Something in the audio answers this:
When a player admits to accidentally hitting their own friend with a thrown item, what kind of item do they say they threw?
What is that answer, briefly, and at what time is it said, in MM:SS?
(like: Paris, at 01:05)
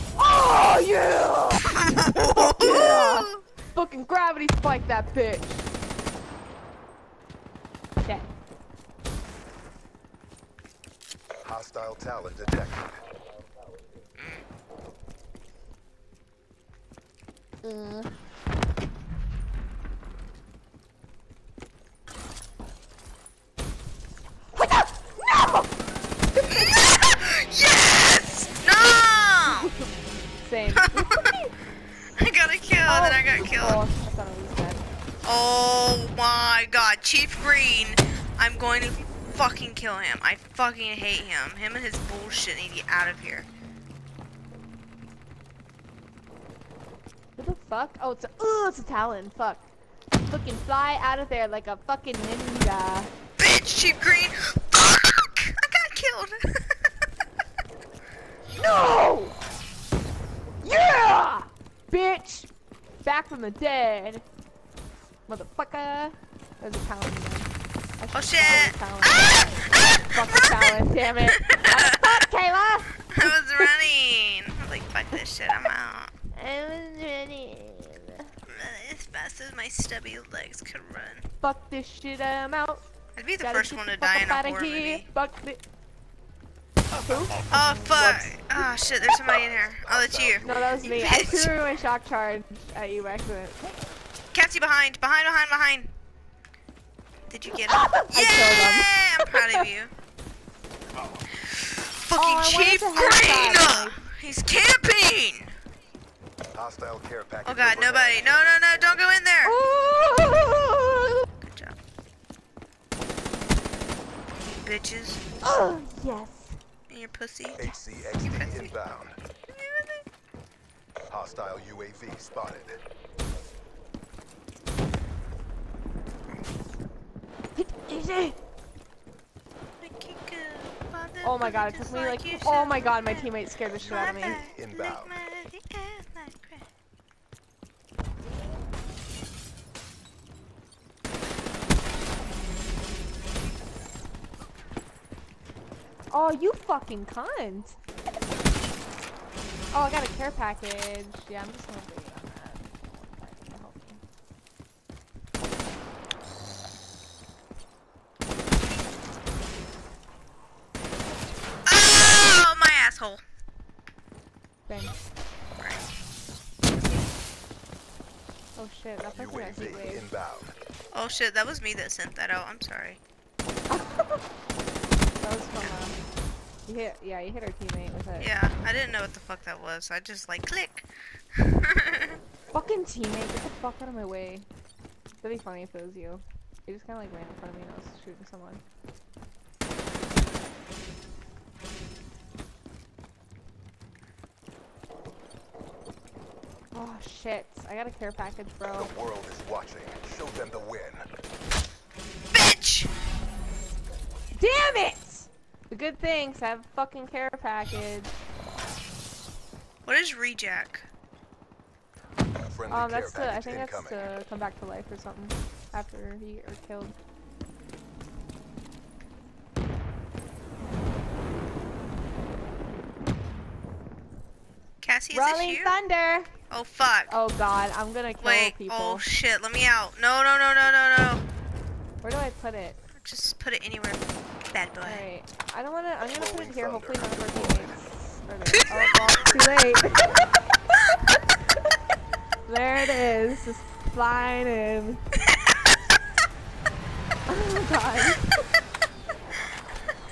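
shock charge, at 01:31.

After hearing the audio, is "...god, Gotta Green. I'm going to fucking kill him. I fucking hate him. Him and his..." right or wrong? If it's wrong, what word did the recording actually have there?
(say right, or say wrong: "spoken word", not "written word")
wrong: "Chief", not "Gotta".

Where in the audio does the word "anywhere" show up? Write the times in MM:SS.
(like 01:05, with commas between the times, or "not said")
03:53.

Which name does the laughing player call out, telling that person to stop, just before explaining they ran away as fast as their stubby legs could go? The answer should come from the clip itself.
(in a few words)
Kayla.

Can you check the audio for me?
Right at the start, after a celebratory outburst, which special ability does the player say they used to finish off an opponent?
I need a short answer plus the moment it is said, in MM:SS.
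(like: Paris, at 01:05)
gravity spike, at 00:04.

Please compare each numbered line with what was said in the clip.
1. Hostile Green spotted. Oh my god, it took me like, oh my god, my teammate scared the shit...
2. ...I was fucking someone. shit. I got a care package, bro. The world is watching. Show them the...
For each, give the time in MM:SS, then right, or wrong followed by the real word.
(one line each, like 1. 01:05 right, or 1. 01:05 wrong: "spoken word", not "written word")
1. 02:01 wrong: "UAV", not "Green"
2. 03:07 wrong: "shooting", not "fucking".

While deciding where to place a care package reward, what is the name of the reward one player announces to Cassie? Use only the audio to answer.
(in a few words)
Rolling Thunder.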